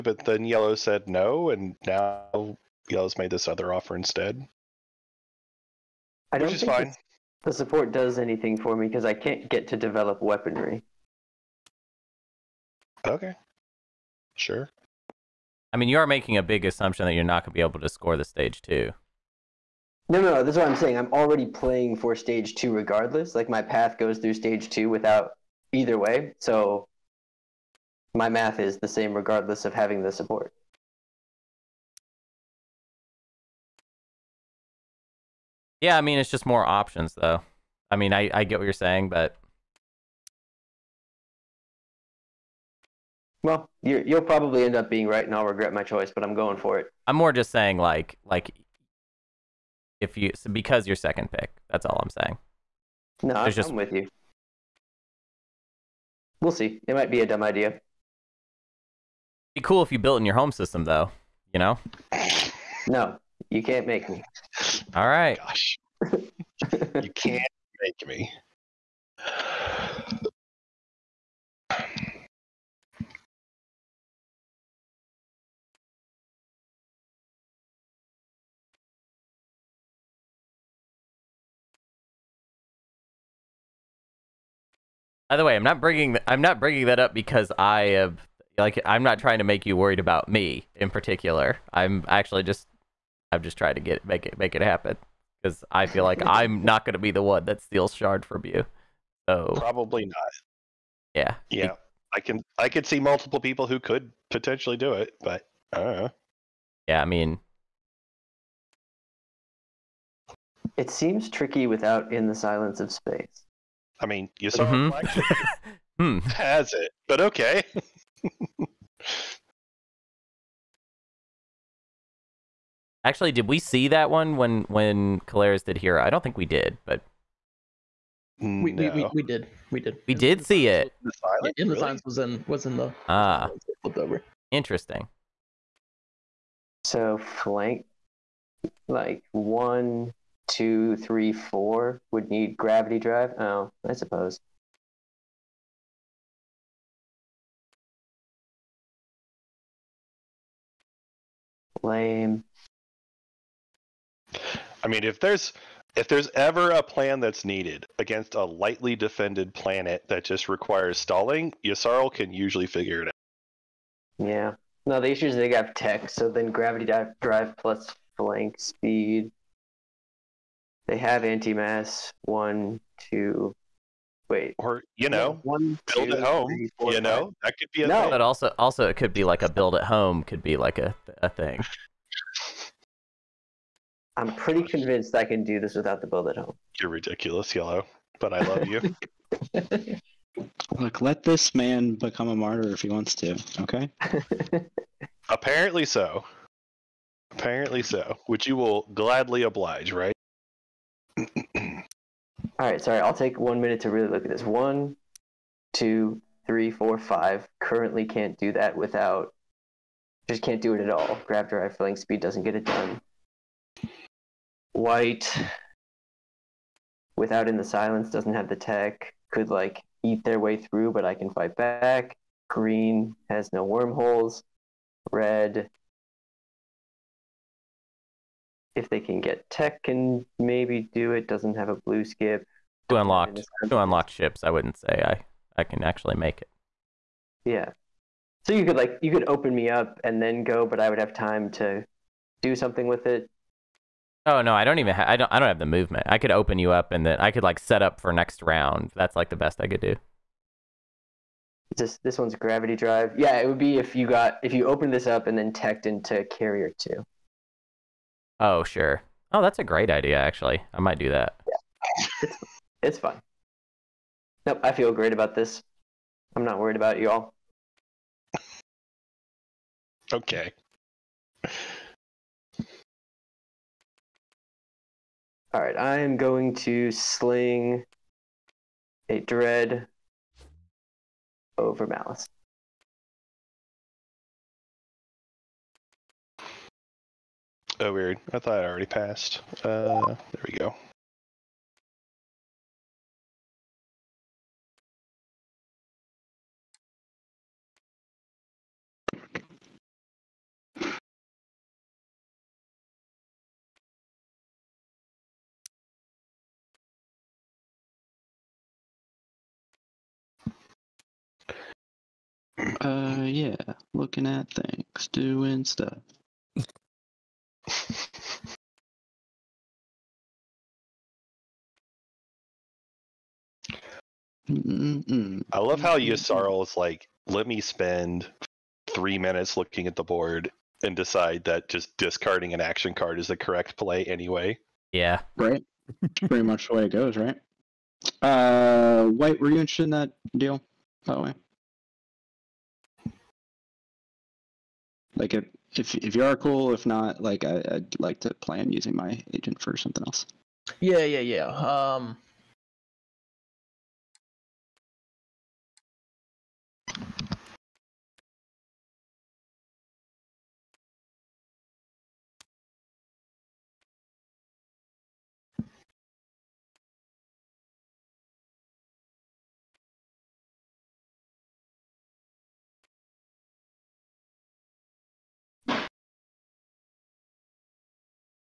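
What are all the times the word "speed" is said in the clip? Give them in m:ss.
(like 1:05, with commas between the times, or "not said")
2:48, 3:31.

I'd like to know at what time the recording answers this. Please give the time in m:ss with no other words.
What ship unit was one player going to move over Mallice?
4:39.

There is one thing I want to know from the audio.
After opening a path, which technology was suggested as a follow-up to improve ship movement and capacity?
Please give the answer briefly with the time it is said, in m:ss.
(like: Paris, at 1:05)
carrier two, at 4:16.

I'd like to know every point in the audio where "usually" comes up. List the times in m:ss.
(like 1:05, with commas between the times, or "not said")
2:42.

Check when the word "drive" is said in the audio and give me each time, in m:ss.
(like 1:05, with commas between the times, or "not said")
2:22, 2:47, 3:31, 4:12.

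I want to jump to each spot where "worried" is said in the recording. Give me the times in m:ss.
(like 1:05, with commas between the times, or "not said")
1:29, 4:26.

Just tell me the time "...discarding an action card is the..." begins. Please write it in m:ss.
5:31.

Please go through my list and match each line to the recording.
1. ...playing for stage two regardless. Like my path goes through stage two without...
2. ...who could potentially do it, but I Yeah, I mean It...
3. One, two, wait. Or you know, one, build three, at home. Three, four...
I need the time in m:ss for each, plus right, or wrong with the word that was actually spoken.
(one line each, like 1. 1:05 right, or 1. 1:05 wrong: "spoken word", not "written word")
1. 0:21 right
2. 1:43 right
3. 2:52 wrong: "two", not "three".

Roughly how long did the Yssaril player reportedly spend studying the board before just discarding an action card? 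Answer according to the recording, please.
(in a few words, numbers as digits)
3 minutes.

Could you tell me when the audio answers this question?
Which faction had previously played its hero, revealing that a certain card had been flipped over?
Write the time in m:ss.
2:05.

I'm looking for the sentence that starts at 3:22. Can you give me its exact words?
I'll take one minute to really look at this.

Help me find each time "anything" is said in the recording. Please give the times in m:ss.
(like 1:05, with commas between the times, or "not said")
0:08.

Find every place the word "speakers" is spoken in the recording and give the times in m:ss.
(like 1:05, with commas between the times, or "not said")
not said.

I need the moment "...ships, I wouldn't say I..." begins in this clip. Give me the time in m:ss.
3:54.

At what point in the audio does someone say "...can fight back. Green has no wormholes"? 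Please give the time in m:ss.
3:41.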